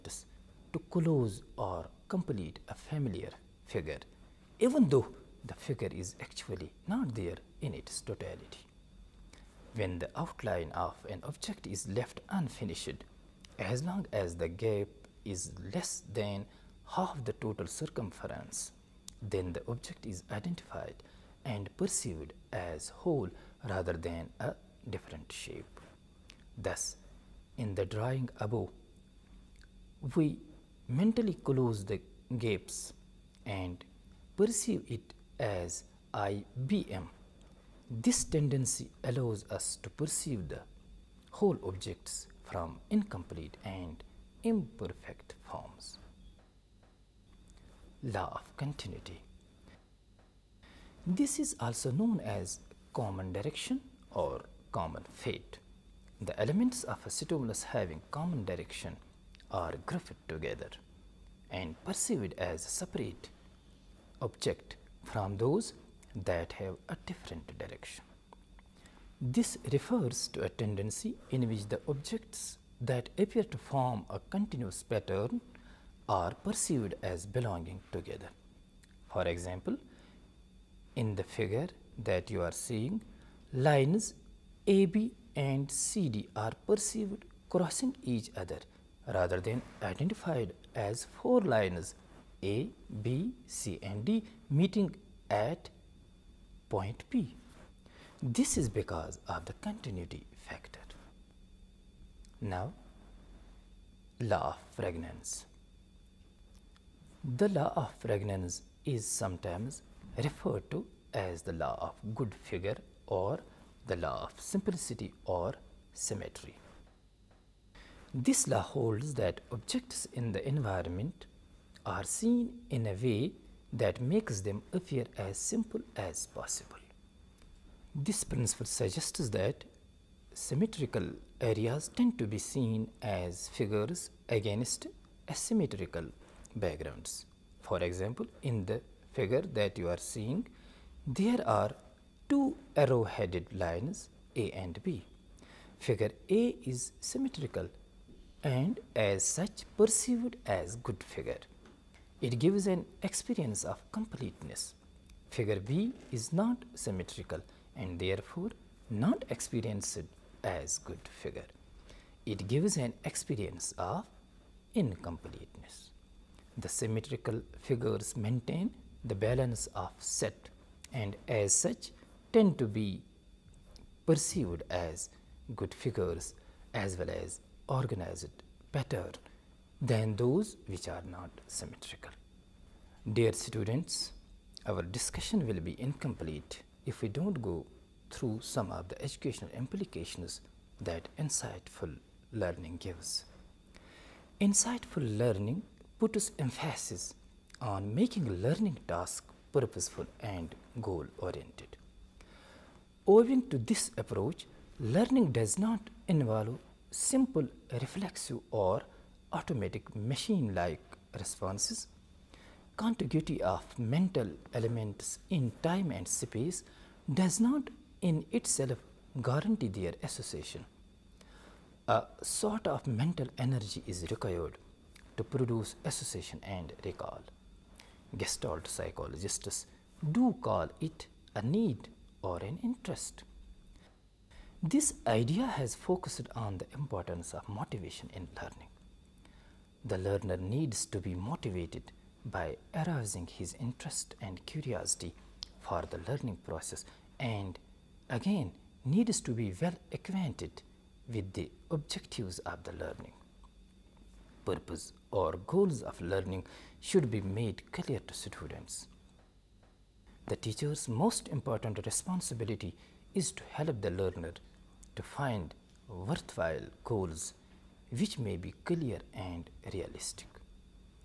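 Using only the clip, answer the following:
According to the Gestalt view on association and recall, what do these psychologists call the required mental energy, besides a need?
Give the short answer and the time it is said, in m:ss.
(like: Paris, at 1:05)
an interest, at 3:52.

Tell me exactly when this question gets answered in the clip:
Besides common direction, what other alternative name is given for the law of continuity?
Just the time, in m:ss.
0:54.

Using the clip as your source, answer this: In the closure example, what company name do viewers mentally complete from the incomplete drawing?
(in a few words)
IBM.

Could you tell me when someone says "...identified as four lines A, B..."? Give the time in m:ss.
1:29.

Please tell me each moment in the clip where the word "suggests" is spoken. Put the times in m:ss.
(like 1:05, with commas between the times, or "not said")
2:08.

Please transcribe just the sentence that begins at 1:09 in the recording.
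This refers to a tendency in which the objects that appear to form a continuous pattern are perceived as belonging together.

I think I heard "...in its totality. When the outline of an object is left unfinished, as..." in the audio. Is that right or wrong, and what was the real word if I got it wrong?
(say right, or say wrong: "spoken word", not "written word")
right.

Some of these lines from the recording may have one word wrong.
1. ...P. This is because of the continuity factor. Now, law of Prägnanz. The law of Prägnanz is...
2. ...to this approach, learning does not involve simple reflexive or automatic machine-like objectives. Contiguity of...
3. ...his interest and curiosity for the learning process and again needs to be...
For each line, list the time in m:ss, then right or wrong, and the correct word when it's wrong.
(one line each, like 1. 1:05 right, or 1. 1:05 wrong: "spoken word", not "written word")
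1. 1:37 right
2. 3:23 wrong: "responses", not "objectives"
3. 4:03 right.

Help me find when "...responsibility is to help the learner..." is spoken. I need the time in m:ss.
4:21.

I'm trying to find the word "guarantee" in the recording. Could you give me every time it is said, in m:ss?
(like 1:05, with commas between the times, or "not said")
3:39.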